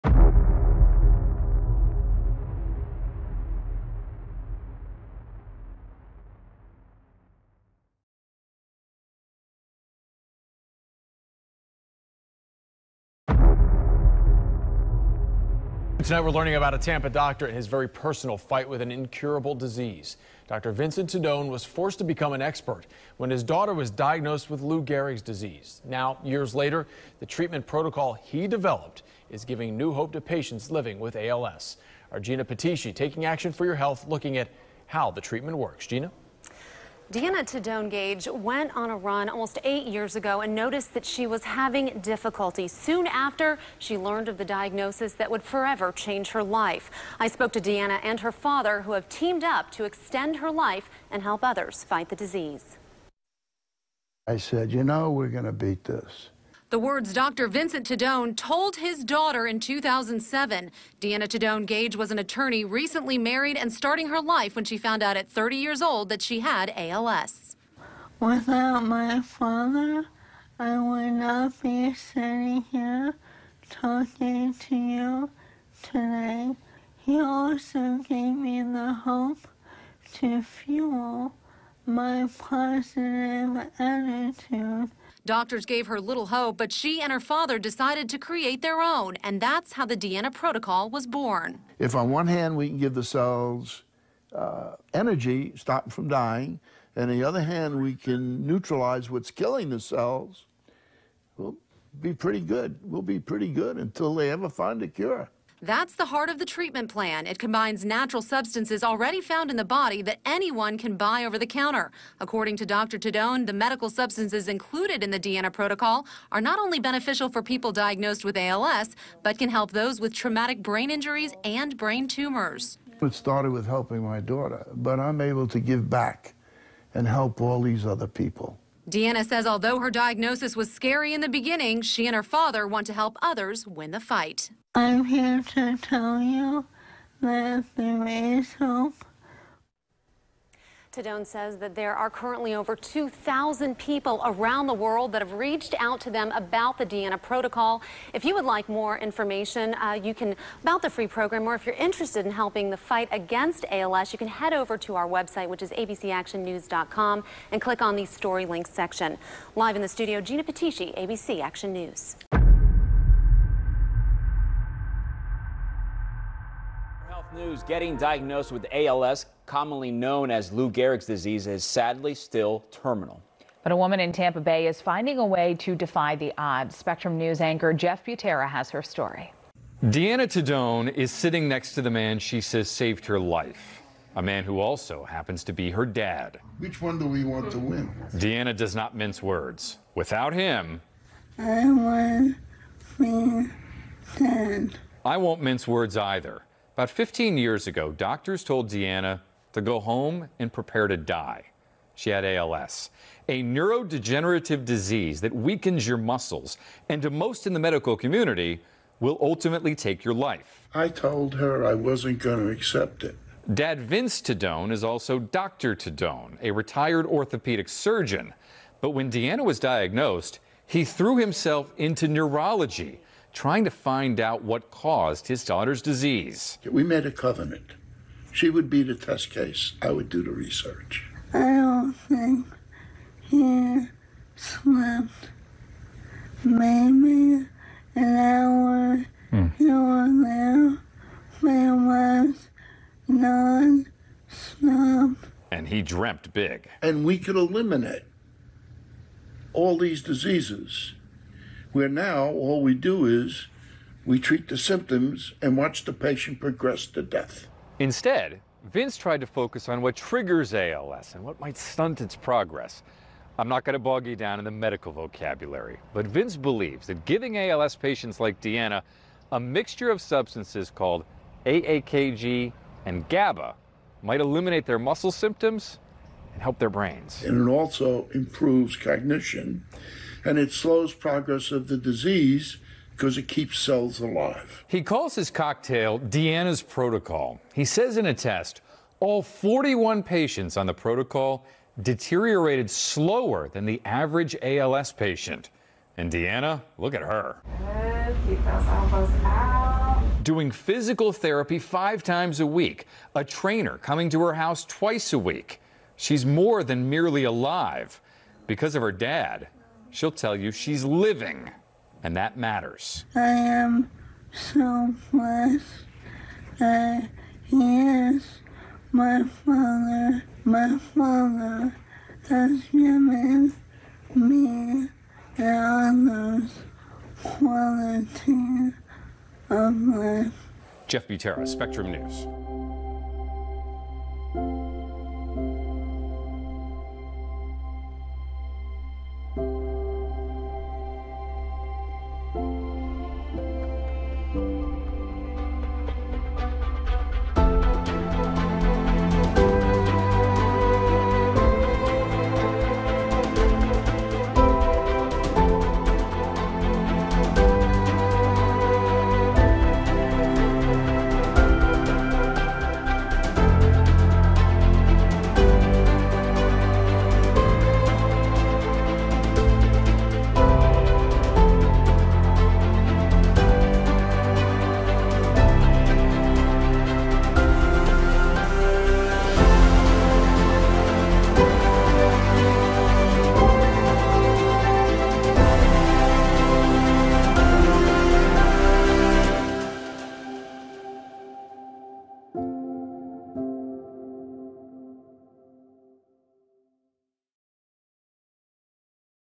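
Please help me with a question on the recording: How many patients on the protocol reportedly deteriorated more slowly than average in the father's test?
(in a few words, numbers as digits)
41.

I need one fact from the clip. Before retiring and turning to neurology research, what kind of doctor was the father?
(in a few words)
Orthopedic surgeon.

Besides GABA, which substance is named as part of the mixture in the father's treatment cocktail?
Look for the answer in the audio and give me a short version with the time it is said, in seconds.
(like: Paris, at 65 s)
AAKG, at 271 s.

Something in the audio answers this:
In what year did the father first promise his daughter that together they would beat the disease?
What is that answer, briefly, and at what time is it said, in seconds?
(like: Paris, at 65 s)
2007, at 59 s.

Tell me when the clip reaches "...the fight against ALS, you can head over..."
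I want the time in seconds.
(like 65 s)
152 s.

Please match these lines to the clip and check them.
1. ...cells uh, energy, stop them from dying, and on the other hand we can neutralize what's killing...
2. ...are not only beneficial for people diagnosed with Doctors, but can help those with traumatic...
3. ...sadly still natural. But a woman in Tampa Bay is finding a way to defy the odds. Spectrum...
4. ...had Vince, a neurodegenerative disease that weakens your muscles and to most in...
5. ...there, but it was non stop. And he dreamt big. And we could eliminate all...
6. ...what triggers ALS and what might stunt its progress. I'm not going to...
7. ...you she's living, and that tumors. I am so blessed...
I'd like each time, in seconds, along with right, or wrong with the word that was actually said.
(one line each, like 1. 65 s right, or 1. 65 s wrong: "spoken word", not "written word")
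1. 93 s right
2. 116 s wrong: "ALS", not "Doctors"
3. 171 s wrong: "terminal", not "natural"
4. 202 s wrong: "ALS", not "Vince"
5. 240 s right
6. 259 s right
7. 310 s wrong: "matters", not "tumors".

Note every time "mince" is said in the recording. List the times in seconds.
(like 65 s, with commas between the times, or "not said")
188 s, 195 s.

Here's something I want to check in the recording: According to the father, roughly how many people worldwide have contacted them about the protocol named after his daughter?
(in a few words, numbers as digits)
Over 2,000.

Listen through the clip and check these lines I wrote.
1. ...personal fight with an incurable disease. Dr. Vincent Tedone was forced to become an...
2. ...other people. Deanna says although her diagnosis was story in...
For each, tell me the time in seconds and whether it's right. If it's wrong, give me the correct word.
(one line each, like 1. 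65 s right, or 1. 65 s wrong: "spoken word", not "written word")
1. 17 s right
2. 127 s wrong: "scary", not "story".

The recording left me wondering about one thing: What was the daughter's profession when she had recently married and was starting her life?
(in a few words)
Attorney.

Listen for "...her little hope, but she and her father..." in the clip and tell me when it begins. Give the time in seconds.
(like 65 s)
85 s.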